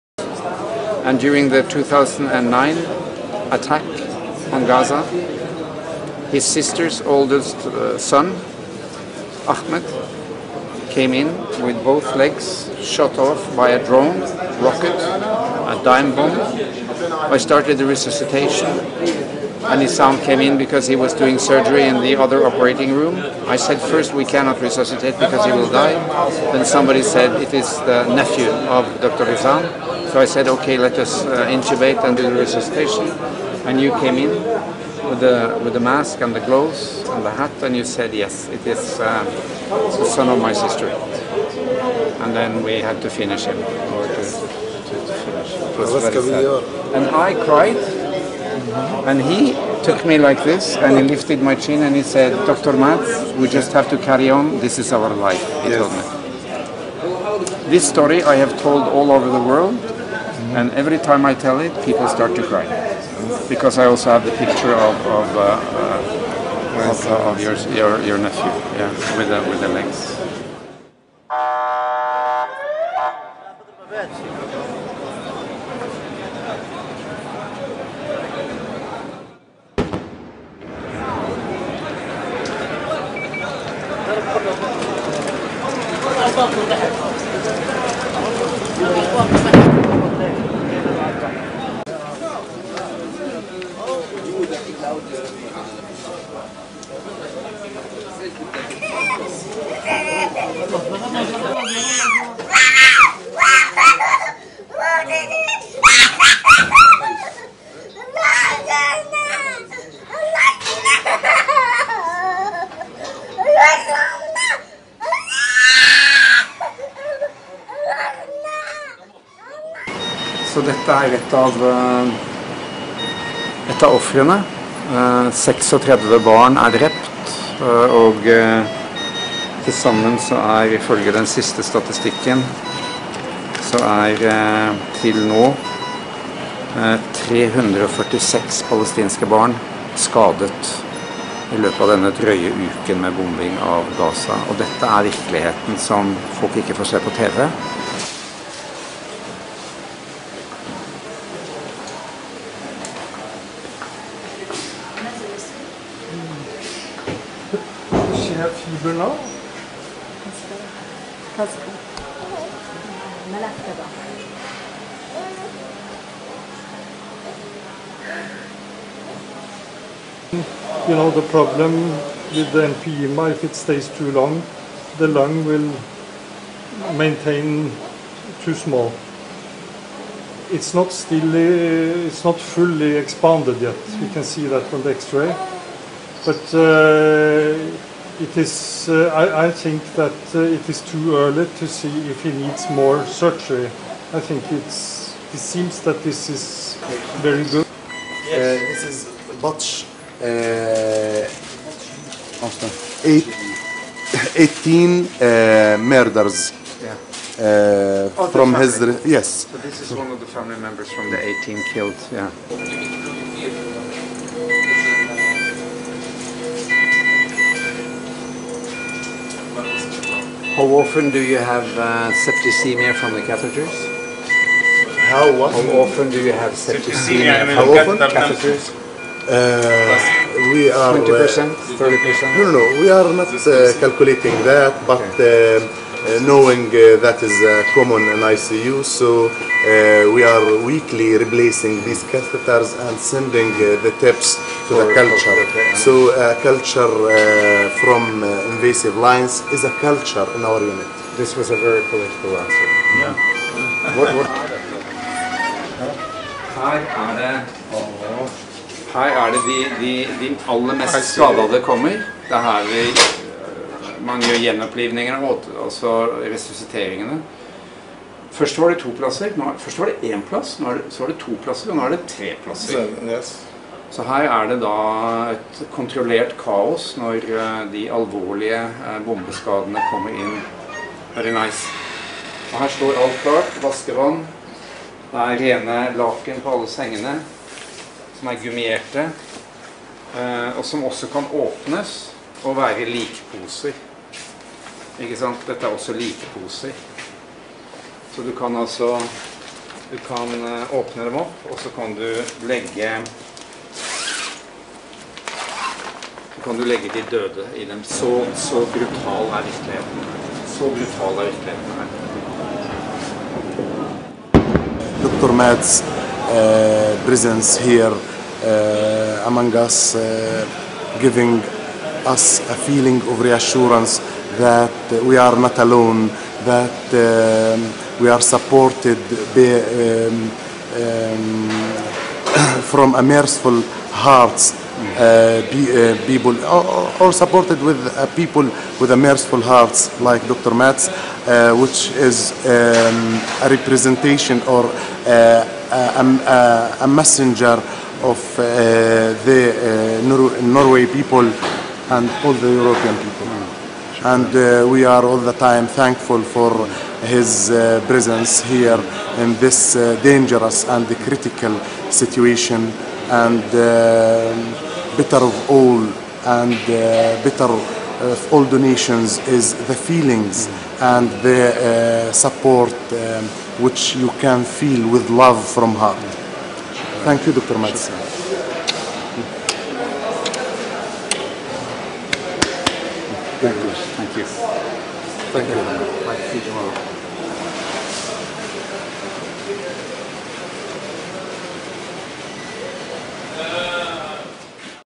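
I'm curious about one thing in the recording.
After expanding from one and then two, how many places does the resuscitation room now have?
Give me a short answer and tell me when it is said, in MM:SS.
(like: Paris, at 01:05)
3, at 04:32.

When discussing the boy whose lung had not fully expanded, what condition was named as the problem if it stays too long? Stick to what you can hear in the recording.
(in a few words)
empyema.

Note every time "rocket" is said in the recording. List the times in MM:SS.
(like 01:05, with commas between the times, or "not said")
00:14.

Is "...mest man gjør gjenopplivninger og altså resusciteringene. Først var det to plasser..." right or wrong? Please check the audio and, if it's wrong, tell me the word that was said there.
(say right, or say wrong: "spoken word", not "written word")
right.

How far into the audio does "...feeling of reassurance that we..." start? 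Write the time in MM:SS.
05:22.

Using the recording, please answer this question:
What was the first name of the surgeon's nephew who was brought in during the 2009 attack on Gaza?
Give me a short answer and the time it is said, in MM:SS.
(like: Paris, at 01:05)
Ahmed, at 00:09.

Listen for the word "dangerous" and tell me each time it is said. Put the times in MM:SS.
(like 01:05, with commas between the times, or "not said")
06:00.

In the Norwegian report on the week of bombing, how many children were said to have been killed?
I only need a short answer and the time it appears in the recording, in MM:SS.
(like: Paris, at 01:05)
36, at 02:05.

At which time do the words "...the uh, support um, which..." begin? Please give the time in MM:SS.
06:11.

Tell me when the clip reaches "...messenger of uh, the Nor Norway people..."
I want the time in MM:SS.
05:46.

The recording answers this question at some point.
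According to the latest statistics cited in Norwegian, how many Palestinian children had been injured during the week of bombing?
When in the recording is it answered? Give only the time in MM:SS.
02:17.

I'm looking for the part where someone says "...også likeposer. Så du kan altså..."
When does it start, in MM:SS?
04:55.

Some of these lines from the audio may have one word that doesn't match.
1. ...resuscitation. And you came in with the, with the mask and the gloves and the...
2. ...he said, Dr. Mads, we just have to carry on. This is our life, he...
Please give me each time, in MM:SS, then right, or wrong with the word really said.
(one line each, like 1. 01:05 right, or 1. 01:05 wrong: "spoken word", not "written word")
1. 00:32 right
2. 00:51 right.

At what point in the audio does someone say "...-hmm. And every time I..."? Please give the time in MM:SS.
01:00.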